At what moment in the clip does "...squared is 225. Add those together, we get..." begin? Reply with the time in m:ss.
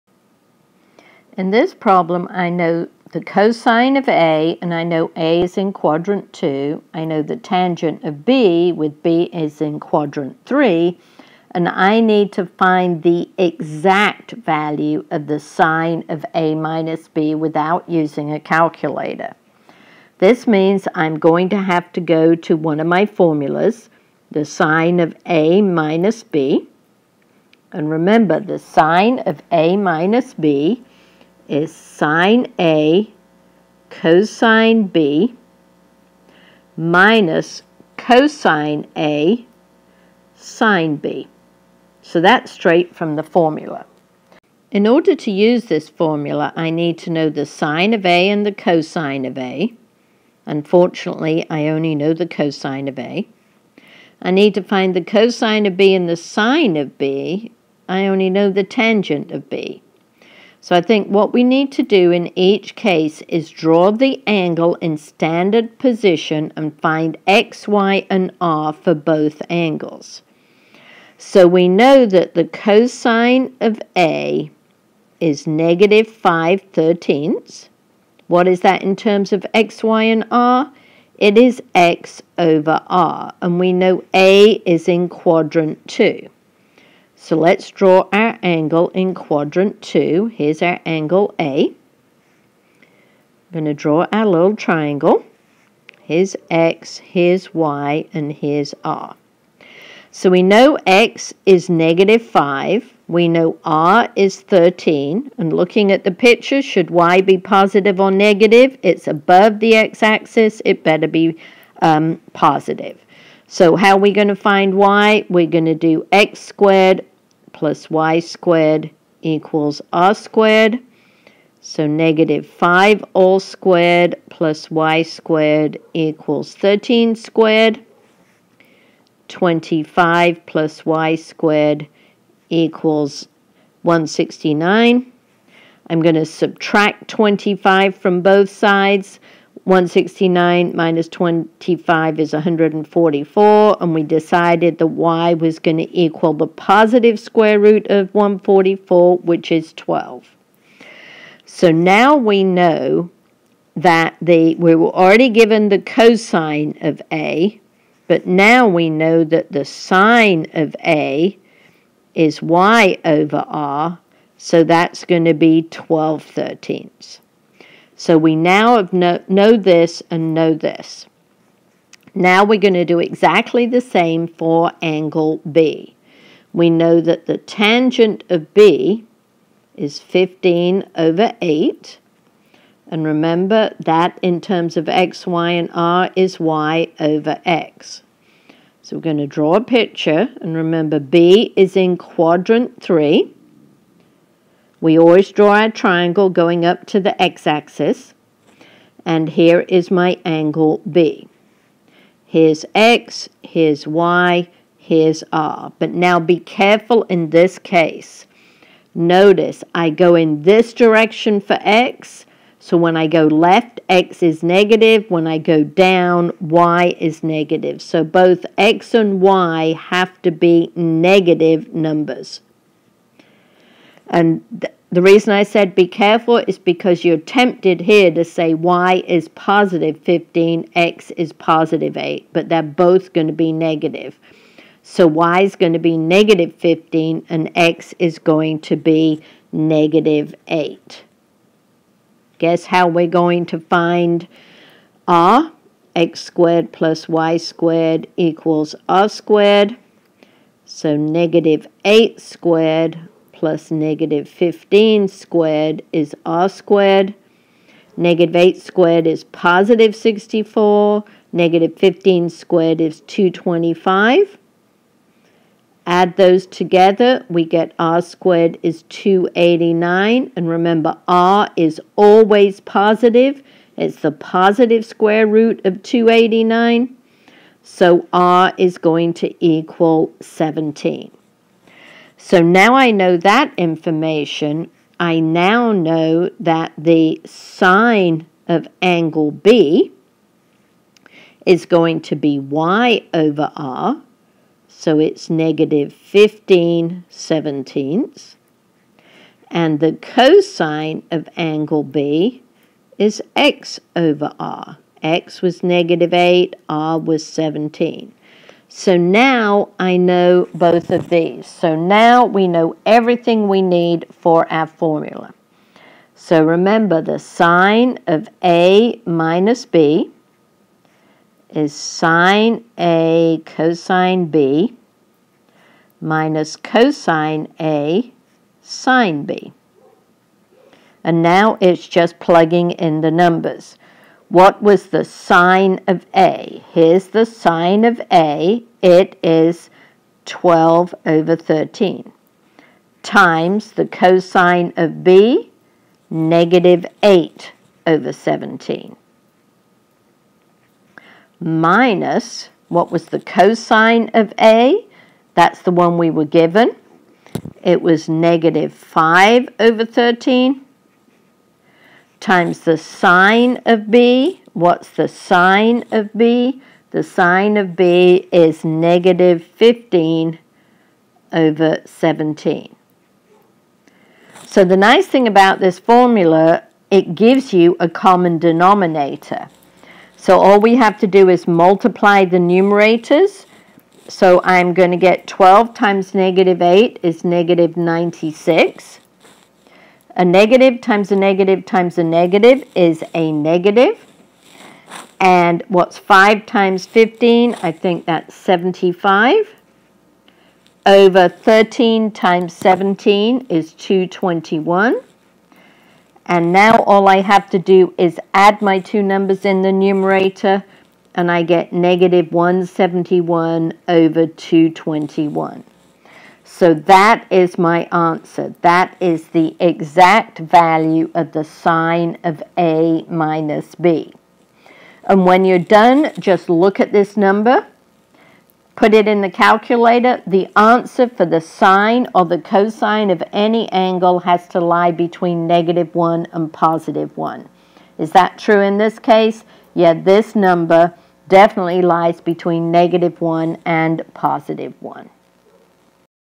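4:22.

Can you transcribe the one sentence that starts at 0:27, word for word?
And remember, the sine of A minus B is sine A cosine B minus cosine A sine B.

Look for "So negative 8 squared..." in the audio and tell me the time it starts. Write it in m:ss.
4:10.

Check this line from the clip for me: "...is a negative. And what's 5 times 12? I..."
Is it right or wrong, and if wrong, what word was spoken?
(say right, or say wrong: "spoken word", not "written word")
wrong: "15", not "12".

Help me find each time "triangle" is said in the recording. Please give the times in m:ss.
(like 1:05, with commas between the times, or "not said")
1:34, 3:15.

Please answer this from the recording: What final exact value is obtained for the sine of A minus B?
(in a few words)
-171/221.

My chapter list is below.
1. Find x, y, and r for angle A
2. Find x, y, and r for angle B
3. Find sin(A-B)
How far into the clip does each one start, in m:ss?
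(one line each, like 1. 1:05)
1. 1:12
2. 2:55
3. 5:18.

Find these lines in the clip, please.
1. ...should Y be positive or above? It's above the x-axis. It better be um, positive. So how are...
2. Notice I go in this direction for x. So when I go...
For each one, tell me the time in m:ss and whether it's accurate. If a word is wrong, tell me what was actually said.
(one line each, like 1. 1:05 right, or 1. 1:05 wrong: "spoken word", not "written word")
1. 1:46 wrong: "negative", not "above"
2. 3:28 right.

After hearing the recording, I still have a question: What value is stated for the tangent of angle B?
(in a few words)
15/8.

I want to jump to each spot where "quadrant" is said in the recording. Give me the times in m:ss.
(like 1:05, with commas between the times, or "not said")
0:05, 0:09, 1:25, 1:29, 3:11.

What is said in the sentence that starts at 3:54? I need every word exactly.
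So y is going to be negative 15 and x is going to be negative 8.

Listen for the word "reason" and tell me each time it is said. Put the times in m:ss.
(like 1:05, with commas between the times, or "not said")
3:45.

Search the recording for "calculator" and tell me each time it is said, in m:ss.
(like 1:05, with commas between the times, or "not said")
0:18, 7:09.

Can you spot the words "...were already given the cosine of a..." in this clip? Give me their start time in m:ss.
2:34.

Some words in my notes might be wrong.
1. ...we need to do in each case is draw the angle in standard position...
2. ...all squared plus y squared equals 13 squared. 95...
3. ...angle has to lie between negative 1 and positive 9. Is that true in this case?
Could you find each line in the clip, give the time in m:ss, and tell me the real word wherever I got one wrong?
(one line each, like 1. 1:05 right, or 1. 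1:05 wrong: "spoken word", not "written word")
1. 1:01 right
2. 2:03 wrong: "25", not "95"
3. 7:13 wrong: "1", not "9".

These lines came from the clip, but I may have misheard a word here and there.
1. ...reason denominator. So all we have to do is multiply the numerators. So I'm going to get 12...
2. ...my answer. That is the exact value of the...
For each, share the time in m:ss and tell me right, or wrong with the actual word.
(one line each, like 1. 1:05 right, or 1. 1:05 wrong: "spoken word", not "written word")
1. 6:17 wrong: "common", not "reason"
2. 6:57 right.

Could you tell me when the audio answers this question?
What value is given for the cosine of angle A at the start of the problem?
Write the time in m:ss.
1:15.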